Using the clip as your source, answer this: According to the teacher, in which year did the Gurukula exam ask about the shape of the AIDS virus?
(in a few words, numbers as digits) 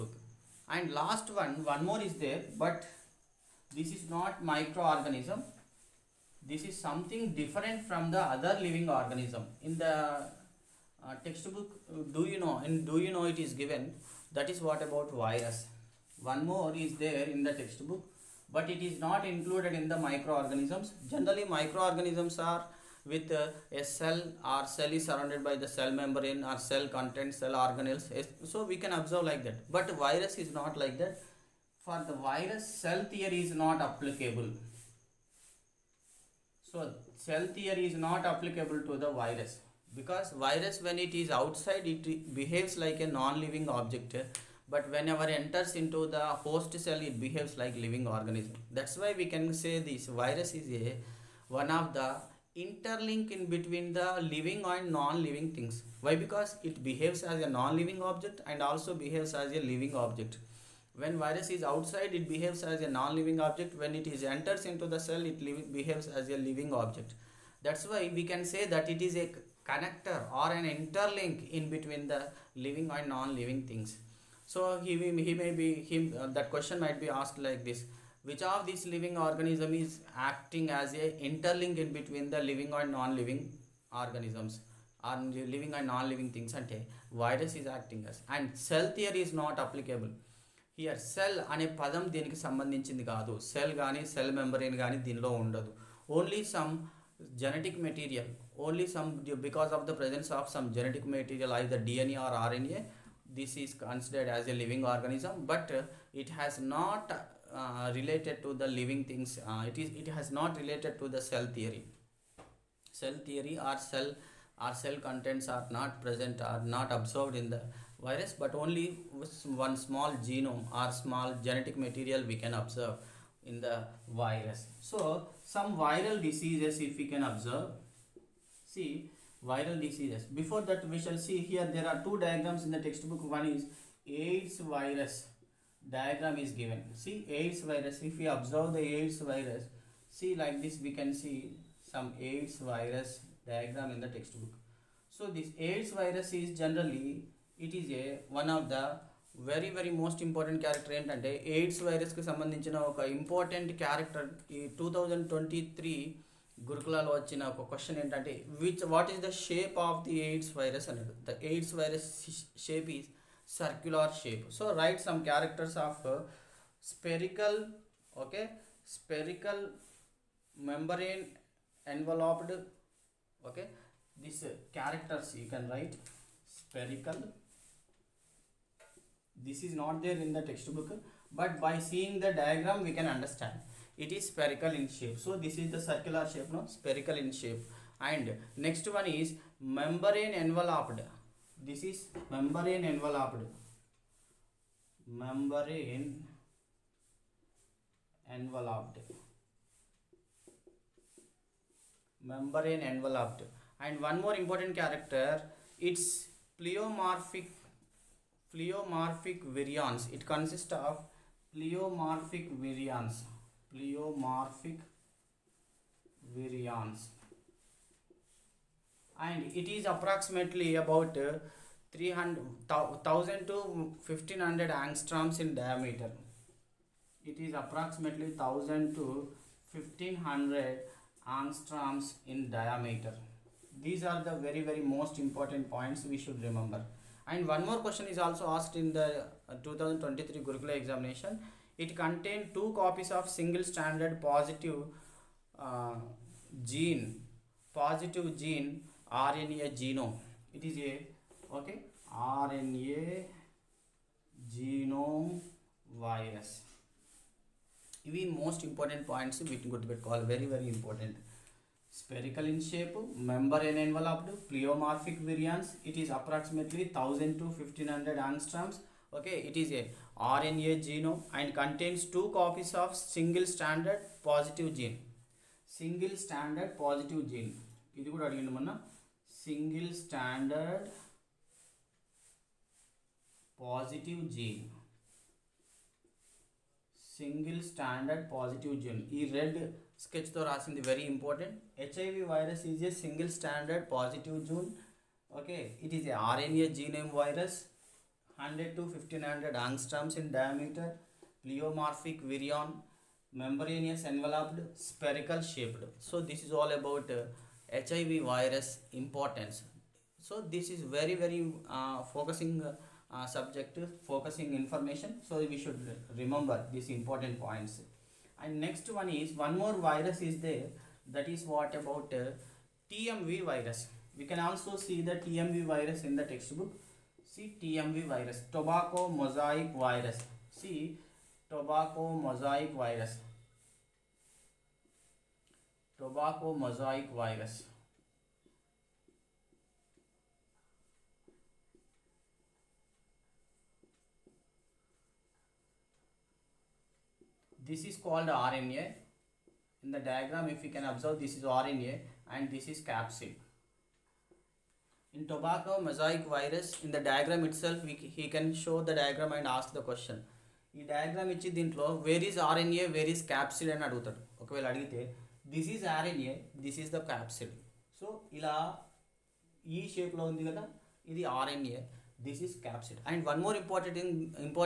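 2023.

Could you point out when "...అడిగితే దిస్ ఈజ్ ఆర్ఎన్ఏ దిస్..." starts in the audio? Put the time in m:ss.
6:04.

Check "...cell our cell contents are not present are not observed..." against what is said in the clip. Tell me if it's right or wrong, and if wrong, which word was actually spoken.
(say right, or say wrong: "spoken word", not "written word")
right.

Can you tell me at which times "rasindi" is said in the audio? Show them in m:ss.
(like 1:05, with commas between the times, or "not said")
4:50.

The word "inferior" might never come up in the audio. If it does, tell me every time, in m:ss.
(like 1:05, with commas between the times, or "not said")
not said.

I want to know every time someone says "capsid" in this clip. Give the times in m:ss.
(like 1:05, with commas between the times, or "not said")
5:52.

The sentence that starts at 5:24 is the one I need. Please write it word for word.
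We can also see the TMV virus in the textbook.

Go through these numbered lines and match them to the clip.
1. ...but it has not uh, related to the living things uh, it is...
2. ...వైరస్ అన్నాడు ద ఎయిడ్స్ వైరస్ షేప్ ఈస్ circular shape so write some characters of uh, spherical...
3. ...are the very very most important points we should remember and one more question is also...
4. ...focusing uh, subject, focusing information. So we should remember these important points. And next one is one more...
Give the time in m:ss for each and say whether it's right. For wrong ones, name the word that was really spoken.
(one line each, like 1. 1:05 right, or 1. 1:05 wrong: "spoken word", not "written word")
1. 1:45 right
2. 2:40 right
3. 3:54 right
4. 5:12 right.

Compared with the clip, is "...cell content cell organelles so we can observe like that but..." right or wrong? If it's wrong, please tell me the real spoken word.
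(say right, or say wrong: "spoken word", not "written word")
right.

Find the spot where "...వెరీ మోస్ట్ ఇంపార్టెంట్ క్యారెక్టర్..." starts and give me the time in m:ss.
2:29.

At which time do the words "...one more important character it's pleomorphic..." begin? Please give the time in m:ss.
3:24.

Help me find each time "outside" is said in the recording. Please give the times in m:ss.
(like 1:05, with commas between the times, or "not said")
0:41, 1:01.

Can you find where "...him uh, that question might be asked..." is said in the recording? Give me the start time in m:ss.
1:15.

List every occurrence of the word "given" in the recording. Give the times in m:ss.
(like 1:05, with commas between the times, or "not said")
0:13, 2:16.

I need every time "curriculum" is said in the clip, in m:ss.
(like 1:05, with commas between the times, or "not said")
not said.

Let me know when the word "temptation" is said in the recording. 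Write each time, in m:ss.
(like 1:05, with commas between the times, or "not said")
not said.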